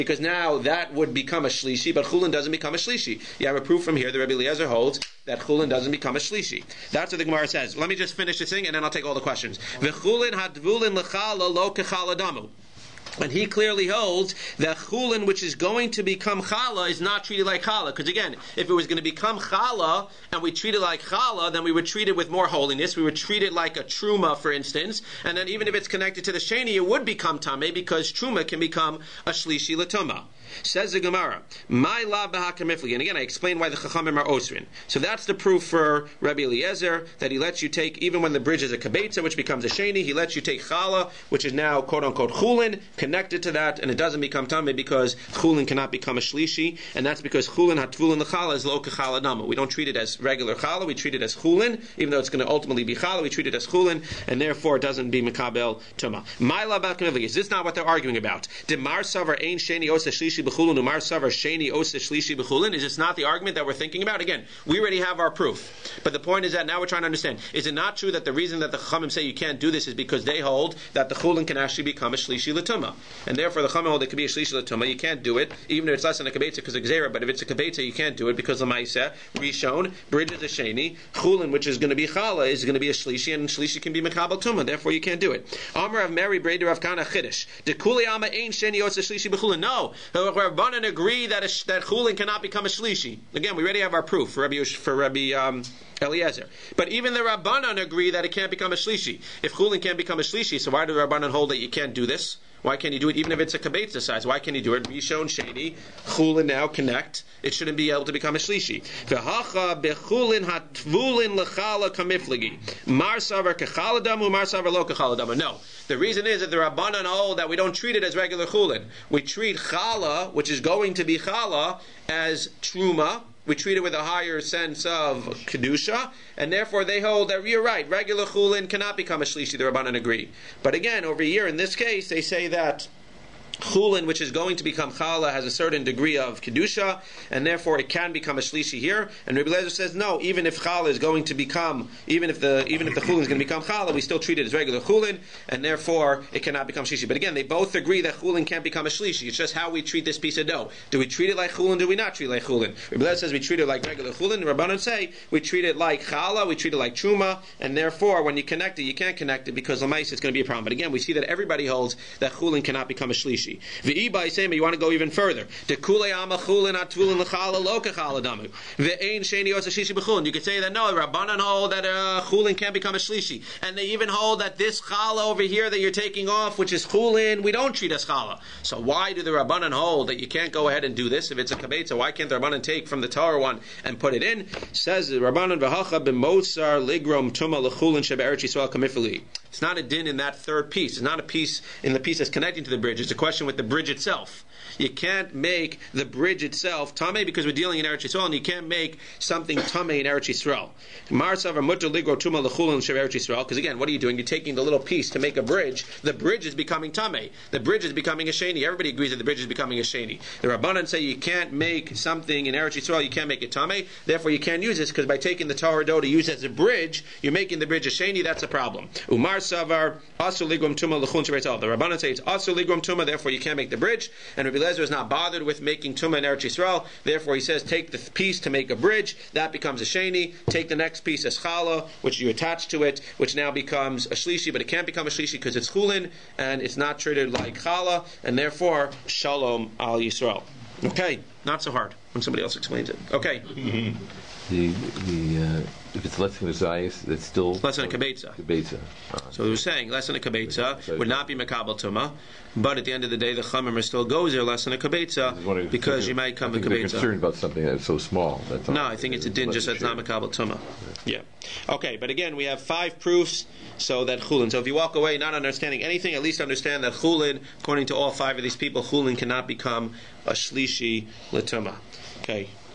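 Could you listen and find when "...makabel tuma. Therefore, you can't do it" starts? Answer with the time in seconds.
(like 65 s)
84 s.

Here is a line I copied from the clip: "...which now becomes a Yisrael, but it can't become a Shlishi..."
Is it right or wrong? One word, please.
wrong.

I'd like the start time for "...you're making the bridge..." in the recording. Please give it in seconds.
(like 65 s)
217 s.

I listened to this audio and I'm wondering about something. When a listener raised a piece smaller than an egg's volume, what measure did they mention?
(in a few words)
a zayis.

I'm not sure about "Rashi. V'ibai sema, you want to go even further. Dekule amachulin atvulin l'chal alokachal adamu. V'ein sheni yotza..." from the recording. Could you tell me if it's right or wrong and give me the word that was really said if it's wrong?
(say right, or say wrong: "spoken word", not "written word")
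right.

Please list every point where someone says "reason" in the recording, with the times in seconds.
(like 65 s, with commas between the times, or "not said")
68 s, 115 s.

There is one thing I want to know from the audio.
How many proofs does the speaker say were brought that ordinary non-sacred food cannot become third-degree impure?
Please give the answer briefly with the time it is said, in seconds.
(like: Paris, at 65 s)
5, at 262 s.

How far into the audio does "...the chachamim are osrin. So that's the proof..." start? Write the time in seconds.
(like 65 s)
33 s.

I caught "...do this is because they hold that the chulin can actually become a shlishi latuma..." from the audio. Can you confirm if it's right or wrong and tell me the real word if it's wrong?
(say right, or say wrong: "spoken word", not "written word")
right.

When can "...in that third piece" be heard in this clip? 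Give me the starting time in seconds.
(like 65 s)
190 s.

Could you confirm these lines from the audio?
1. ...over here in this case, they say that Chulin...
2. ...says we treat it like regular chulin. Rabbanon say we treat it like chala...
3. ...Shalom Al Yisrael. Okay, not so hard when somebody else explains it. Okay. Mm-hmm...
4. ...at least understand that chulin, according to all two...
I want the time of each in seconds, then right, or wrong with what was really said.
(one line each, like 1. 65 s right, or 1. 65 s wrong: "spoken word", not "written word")
1. 131 s right
2. 153 s right
3. 239 s right
4. 266 s wrong: "five", not "two".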